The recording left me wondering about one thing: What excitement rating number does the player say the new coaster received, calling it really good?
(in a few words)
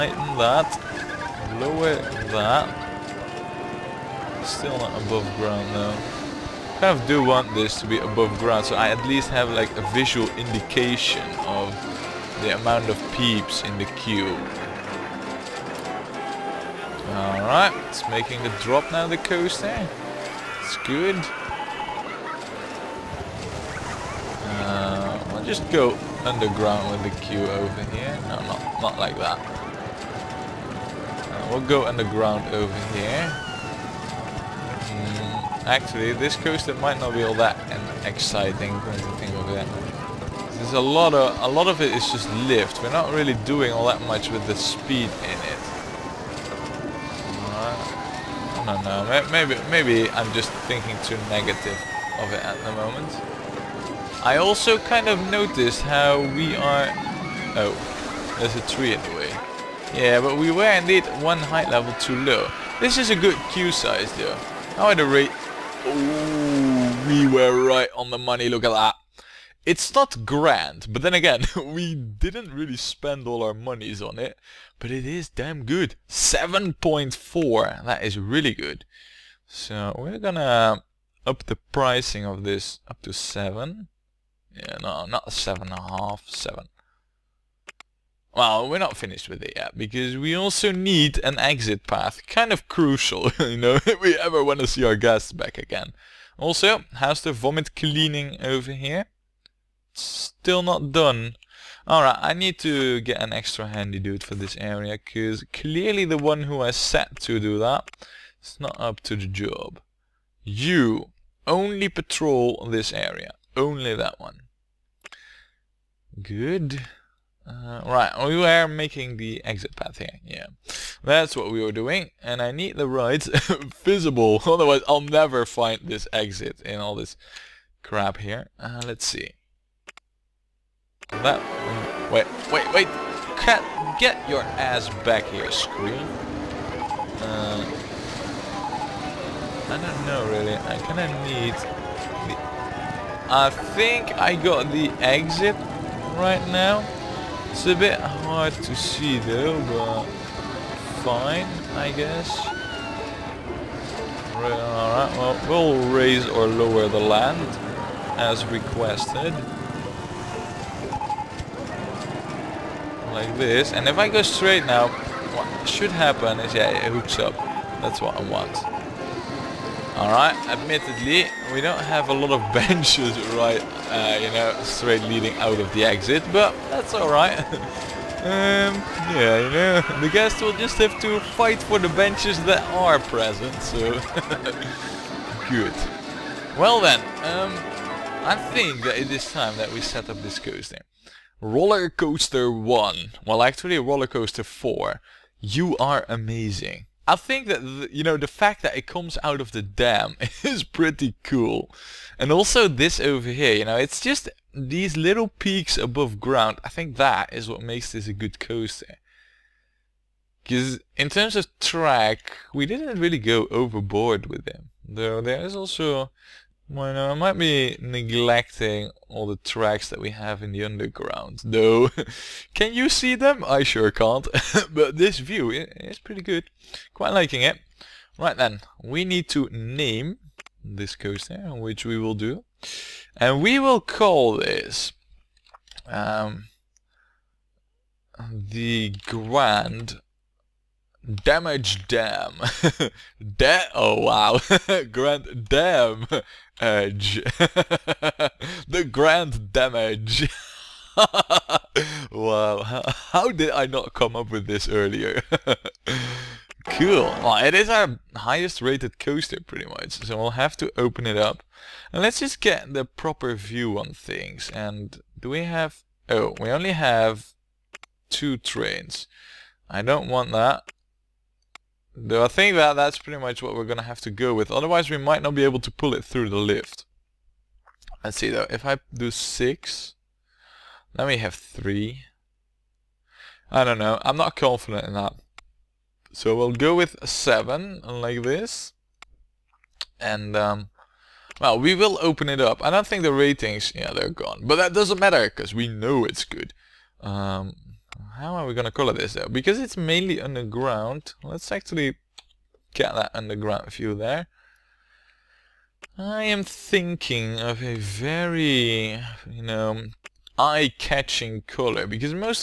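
7.4.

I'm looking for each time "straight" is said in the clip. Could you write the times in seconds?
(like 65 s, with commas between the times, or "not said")
164 s, 174 s.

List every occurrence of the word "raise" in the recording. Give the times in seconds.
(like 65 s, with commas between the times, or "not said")
155 s.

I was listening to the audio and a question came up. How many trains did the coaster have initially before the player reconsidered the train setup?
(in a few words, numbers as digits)
2.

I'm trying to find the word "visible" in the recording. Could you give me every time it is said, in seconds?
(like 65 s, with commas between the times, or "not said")
123 s.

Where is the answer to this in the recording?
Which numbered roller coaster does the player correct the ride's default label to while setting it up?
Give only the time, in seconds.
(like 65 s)
193 s.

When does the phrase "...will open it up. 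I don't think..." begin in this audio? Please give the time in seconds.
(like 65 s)
291 s.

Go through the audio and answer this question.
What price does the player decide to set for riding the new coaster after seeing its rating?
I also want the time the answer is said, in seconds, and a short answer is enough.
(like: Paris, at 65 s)
7, at 86 s.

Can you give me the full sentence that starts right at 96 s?
Also, how's the vomit cleaning over here?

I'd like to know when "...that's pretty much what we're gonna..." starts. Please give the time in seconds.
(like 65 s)
272 s.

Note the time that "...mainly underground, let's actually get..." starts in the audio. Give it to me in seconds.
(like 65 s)
299 s.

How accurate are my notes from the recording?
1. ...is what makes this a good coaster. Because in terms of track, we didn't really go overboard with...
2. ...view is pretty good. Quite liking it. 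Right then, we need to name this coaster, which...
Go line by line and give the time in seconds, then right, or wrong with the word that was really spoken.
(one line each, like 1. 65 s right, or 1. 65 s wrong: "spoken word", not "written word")
1. 207 s right
2. 225 s right.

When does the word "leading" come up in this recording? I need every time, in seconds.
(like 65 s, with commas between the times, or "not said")
175 s.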